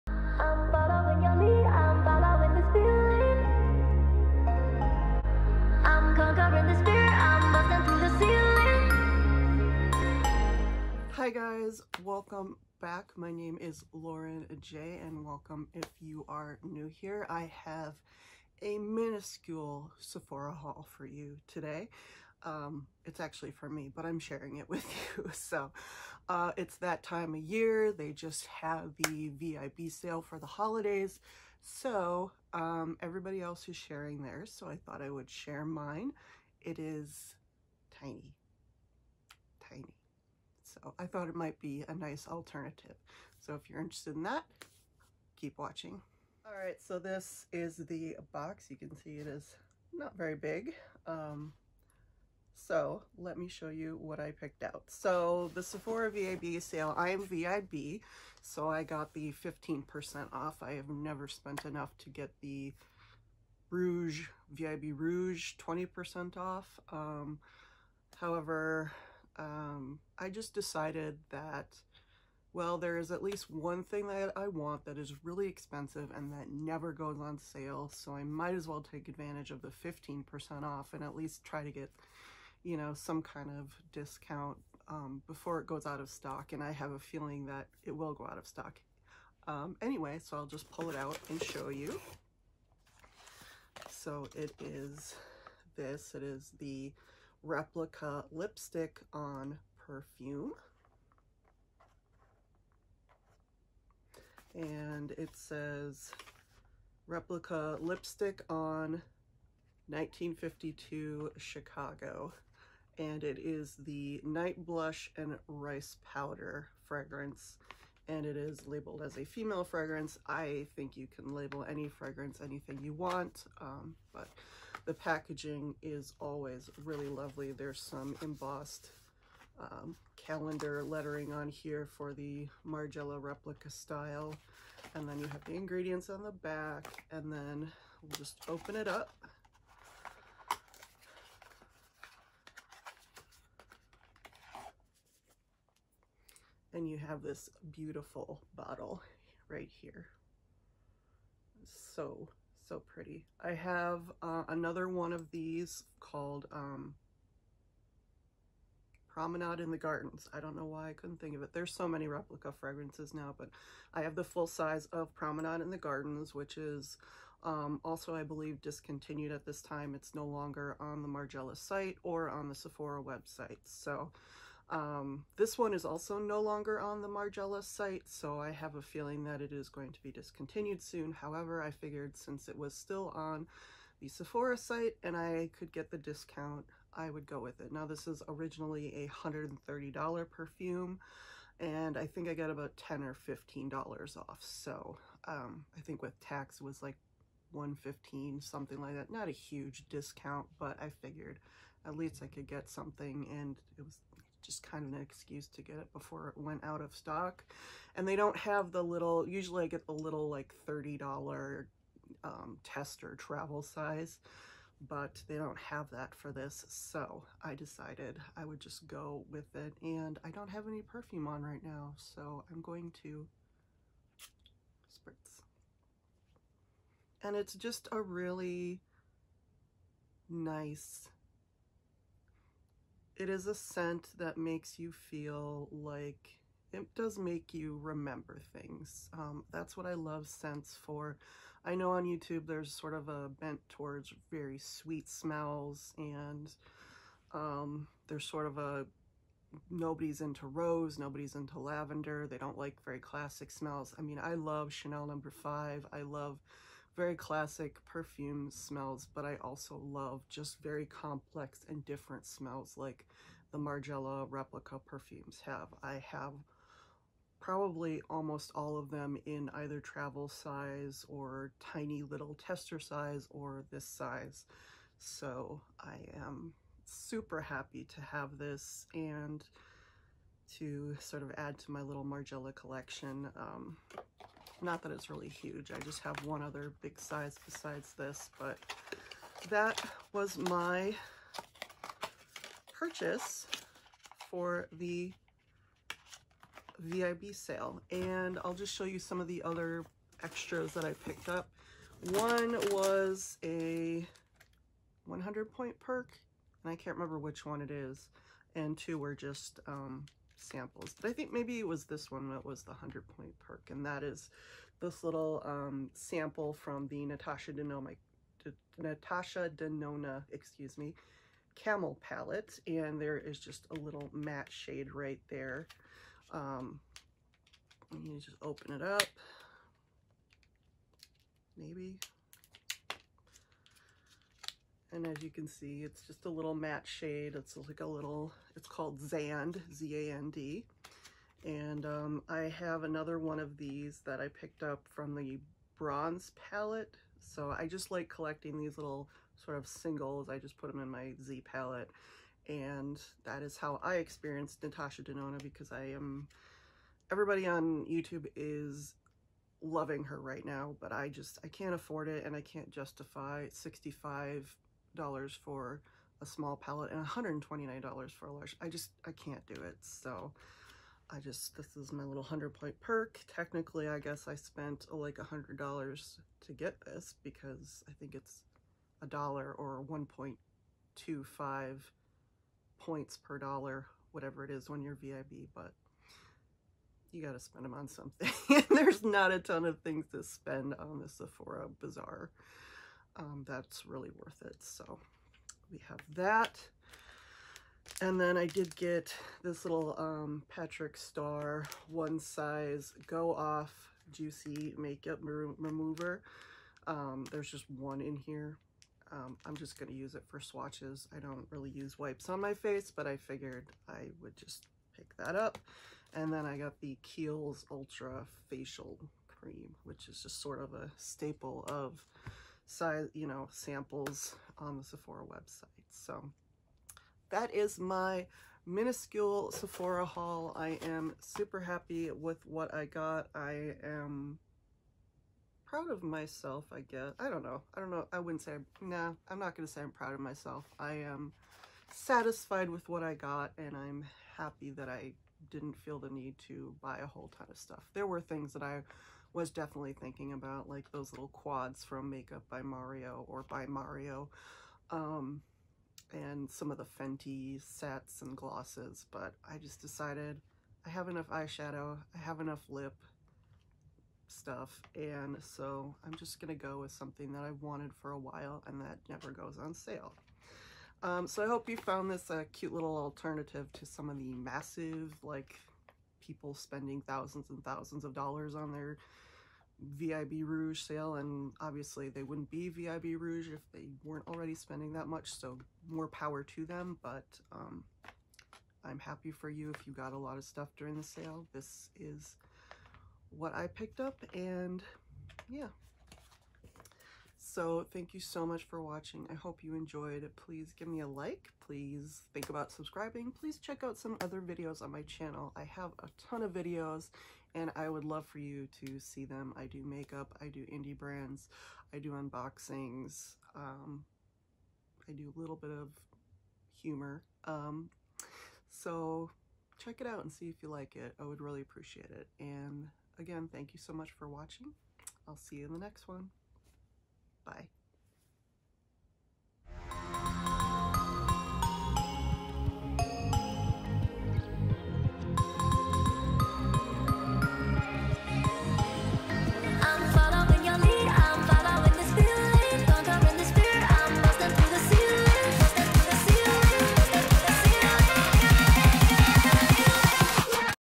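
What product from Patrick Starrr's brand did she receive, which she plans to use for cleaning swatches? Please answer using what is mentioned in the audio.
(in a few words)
Juicy Makeup Remover.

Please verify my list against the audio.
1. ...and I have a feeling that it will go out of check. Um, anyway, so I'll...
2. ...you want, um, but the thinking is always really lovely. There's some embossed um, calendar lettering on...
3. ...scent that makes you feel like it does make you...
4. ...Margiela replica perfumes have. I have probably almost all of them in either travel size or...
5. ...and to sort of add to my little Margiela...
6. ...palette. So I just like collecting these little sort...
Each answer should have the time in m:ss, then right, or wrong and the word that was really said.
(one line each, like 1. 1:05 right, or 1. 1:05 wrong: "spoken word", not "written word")
1. 1:26 wrong: "stock", not "check"
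2. 2:02 wrong: "packaging", not "thinking"
3. 3:53 right
4. 4:23 right
5. 4:38 right
6. 5:46 right.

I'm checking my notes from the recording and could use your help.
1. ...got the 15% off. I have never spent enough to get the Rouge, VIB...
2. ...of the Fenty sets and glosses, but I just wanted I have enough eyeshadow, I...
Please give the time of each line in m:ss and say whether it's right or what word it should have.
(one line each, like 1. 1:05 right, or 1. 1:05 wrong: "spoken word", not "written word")
1. 0:58 right
2. 7:36 wrong: "decided", not "wanted".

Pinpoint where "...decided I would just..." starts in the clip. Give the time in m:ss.
3:37.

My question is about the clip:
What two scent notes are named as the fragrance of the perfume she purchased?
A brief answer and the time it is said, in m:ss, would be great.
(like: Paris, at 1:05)
Night Blush and Rice Powder, at 1:54.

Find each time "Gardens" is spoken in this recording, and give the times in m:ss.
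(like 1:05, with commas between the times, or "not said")
2:39, 2:45.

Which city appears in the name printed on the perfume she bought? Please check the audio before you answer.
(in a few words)
Chicago.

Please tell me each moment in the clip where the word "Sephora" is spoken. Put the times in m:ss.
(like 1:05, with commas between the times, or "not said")
0:19, 0:55, 2:52, 3:04, 6:31, 7:04, 7:09.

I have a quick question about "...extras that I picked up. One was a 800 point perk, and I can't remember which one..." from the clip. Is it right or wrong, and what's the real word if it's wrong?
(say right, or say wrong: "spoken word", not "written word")
wrong: "100", not "800".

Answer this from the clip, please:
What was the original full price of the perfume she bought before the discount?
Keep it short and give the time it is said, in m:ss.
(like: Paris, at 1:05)
$130, at 3:09.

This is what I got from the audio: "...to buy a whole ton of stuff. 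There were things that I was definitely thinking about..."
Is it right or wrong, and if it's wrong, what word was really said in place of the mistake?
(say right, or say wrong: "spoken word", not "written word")
right.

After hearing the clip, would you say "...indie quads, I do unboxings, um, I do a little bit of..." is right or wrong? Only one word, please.
wrong.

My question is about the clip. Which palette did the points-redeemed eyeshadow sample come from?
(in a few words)
Camel palette.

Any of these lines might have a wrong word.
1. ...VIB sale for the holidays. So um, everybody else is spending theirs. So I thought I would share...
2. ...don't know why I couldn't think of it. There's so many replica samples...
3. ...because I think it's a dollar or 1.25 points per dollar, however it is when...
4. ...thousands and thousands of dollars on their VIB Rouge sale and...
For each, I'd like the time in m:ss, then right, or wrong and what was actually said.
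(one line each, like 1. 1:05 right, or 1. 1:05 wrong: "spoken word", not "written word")
1. 0:29 wrong: "sharing", not "spending"
2. 2:40 wrong: "fragrances", not "samples"
3. 6:17 wrong: "whatever", not "however"
4. 7:57 right.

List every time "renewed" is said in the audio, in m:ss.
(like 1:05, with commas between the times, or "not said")
not said.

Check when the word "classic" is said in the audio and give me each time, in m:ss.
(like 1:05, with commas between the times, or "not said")
4:12, 4:17.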